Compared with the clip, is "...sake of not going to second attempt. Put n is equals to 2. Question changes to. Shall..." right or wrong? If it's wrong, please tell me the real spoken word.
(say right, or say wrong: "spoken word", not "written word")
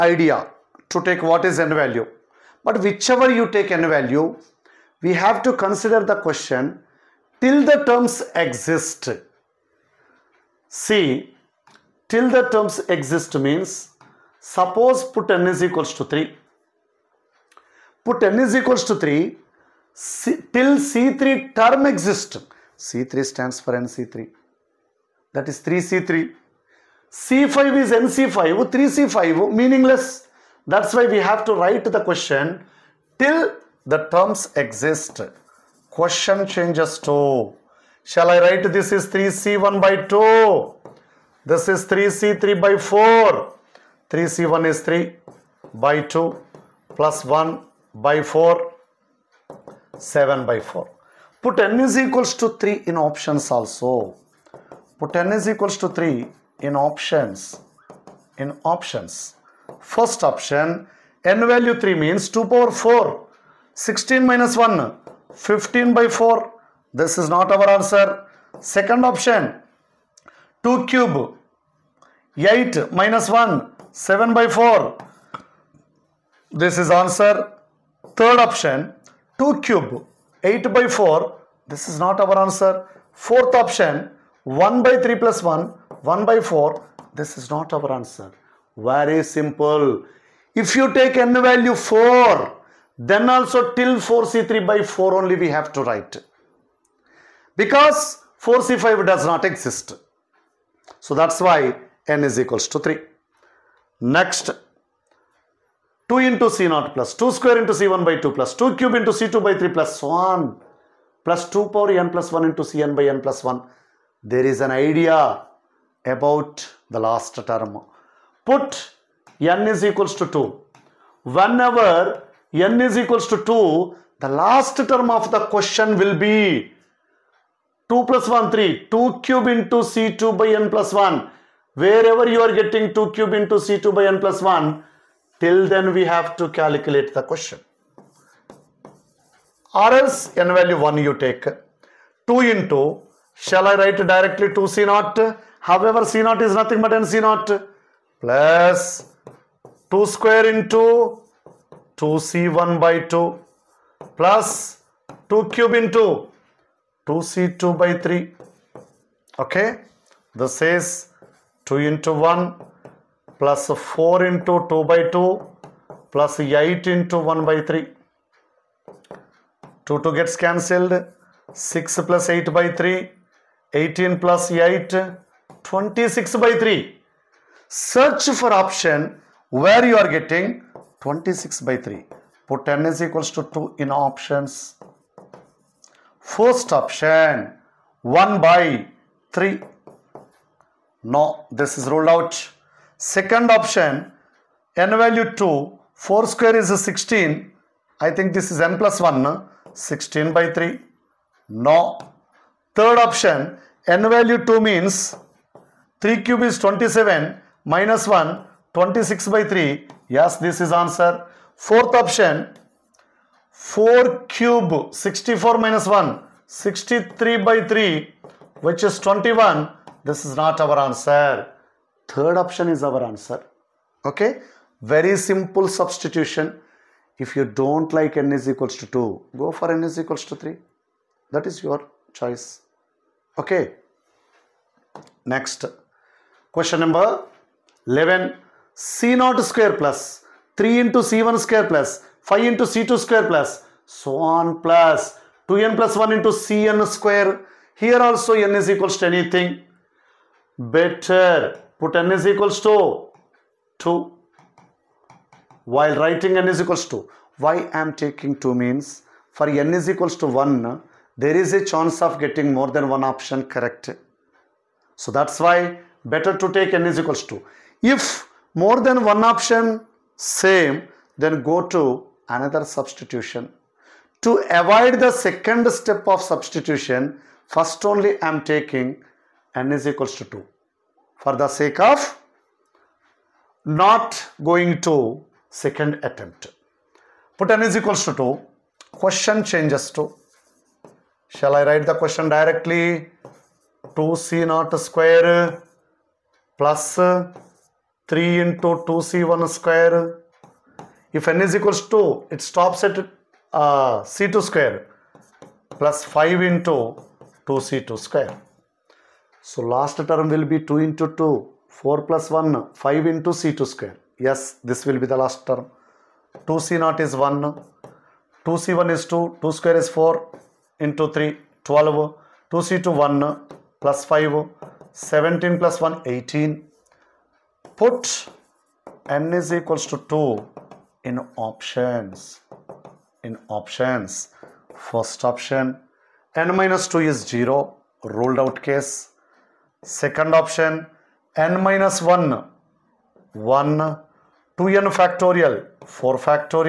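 right.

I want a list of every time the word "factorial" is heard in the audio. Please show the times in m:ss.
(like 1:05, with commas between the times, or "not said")
5:44.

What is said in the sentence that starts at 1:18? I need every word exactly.
Third option, 2 cube, 8 by 4.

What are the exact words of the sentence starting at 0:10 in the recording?
See, till the terms exist means suppose put n is equals to 3.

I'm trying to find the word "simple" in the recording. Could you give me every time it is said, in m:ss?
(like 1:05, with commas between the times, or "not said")
1:29, 3:45.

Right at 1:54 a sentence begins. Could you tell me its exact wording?
There is an idea about the last term put n is equals to 2.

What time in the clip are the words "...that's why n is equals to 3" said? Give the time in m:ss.
1:41.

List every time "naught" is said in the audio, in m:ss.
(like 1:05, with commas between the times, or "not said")
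2:27, 3:59, 4:54.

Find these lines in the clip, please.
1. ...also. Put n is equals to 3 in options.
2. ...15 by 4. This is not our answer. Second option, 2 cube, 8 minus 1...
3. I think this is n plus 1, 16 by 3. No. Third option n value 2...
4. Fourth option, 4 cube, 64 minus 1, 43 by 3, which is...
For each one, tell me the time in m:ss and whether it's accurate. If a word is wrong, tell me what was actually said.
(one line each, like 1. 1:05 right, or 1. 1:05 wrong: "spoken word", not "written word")
1. 0:53 right
2. 1:05 right
3. 3:17 right
4. 3:31 wrong: "63", not "43".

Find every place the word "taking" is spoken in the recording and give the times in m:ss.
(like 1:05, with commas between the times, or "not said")
4:18, 4:38.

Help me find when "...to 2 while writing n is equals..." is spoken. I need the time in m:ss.
4:12.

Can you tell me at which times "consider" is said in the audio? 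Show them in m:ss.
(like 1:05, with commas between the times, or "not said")
0:05.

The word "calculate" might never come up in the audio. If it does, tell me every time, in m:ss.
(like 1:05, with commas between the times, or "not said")
2:16.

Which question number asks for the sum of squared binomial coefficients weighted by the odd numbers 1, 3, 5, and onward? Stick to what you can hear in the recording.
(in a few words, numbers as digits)
11.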